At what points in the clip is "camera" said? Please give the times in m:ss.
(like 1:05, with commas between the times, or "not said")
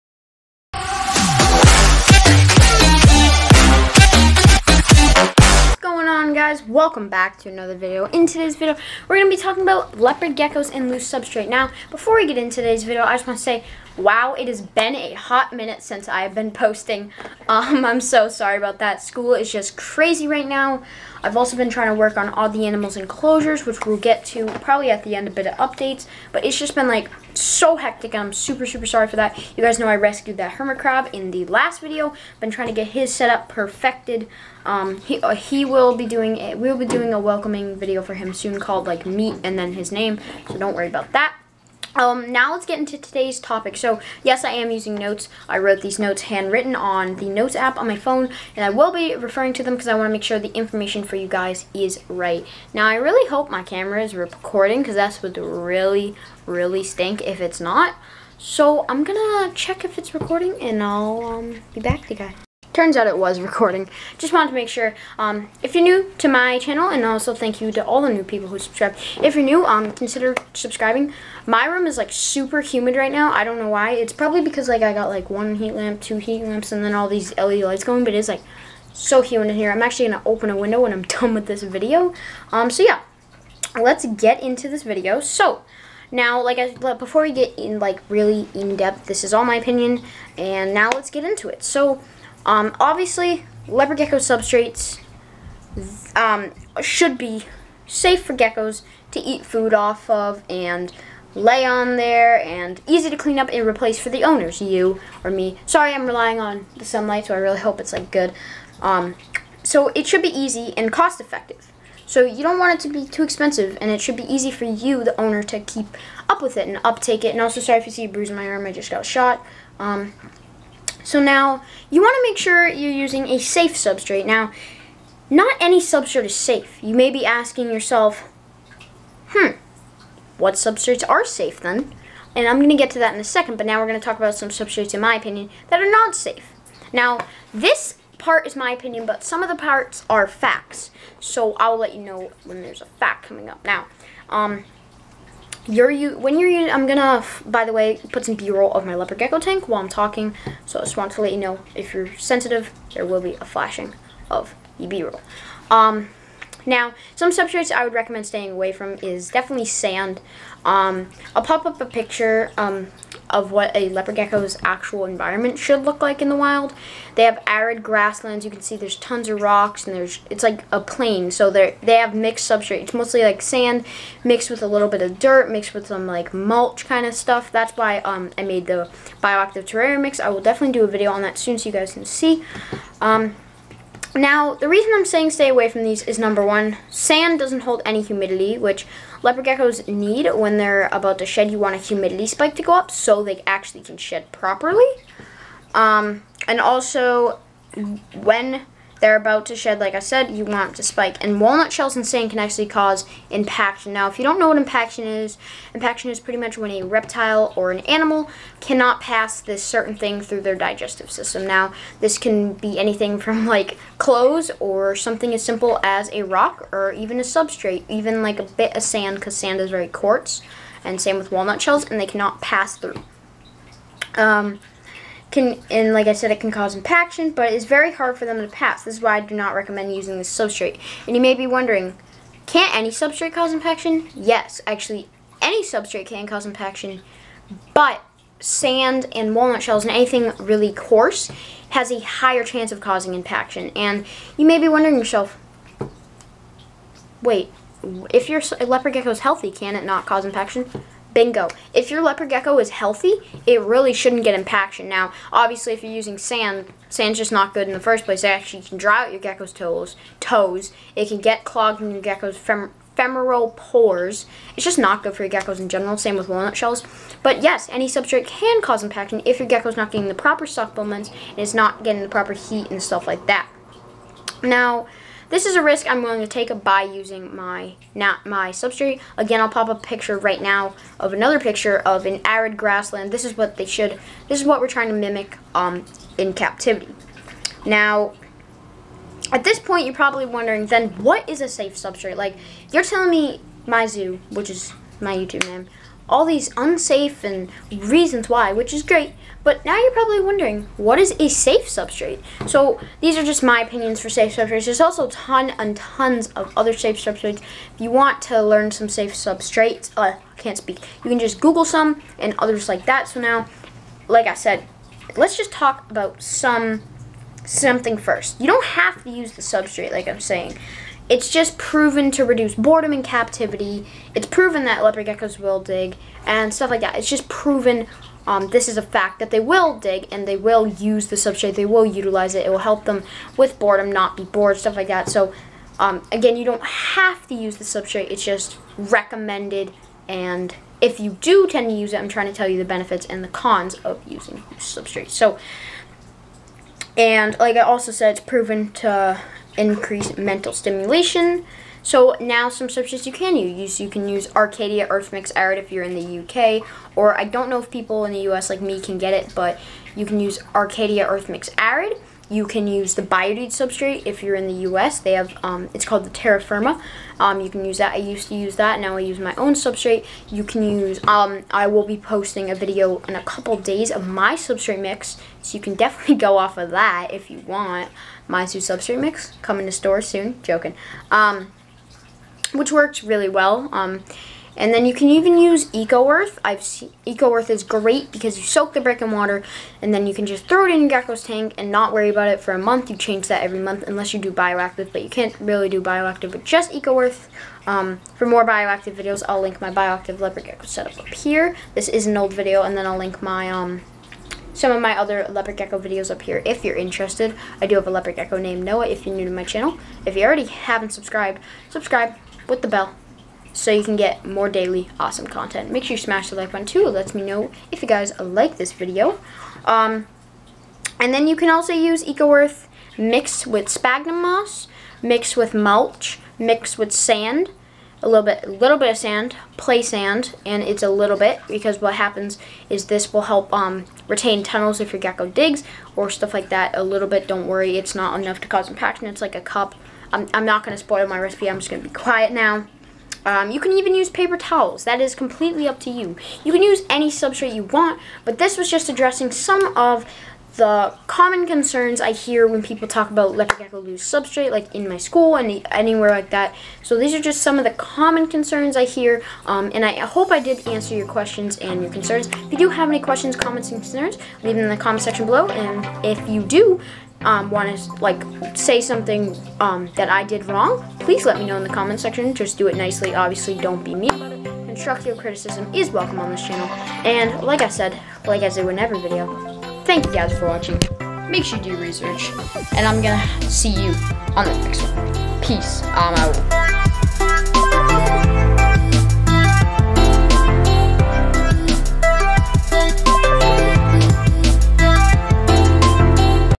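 0:53.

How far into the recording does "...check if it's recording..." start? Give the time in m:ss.
0:59.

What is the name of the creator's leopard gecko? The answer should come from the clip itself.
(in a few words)
Noah.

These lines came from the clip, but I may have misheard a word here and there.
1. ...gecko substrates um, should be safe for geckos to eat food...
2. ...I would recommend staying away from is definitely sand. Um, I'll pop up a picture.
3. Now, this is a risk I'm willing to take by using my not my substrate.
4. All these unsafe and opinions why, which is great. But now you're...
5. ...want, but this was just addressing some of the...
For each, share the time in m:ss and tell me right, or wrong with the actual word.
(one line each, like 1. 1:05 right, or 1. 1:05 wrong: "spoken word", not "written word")
1. 1:33 right
2. 2:37 right
3. 4:34 right
4. 4:56 wrong: "reasons", not "opinions"
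5. 7:27 right.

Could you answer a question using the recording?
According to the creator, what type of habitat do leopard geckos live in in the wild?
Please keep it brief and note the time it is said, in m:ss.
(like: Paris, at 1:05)
arid grasslands, at 2:47.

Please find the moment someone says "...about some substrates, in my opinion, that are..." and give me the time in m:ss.
2:14.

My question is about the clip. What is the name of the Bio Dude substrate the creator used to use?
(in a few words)
Terra Firma.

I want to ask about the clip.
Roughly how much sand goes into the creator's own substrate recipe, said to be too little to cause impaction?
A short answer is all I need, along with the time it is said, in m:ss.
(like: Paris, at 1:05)
a cup, at 7:19.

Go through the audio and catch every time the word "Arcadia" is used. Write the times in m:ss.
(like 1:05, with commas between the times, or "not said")
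5:54, 6:00.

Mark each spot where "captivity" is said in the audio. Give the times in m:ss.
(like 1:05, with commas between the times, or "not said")
4:46, 5:23.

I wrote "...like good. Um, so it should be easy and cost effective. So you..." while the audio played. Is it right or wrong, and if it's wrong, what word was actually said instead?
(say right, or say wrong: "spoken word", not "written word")
right.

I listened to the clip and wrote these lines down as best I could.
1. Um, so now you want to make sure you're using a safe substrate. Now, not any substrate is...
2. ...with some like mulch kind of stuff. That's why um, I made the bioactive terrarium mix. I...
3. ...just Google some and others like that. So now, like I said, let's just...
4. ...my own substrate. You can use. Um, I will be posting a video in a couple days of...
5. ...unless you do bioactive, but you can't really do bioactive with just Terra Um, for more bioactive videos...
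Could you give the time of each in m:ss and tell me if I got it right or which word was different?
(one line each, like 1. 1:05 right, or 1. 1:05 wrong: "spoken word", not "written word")
1. 1:59 right
2. 2:55 right
3. 5:11 right
4. 6:09 right
5. 6:33 wrong: "Eco", not "Terra".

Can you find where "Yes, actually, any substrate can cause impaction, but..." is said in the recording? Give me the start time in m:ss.
3:54.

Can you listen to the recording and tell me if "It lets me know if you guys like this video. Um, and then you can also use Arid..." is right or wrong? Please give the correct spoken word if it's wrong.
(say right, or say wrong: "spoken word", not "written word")
wrong: "EcoEarth", not "Arid".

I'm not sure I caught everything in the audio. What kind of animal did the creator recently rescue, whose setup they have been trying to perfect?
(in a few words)
hermit crab.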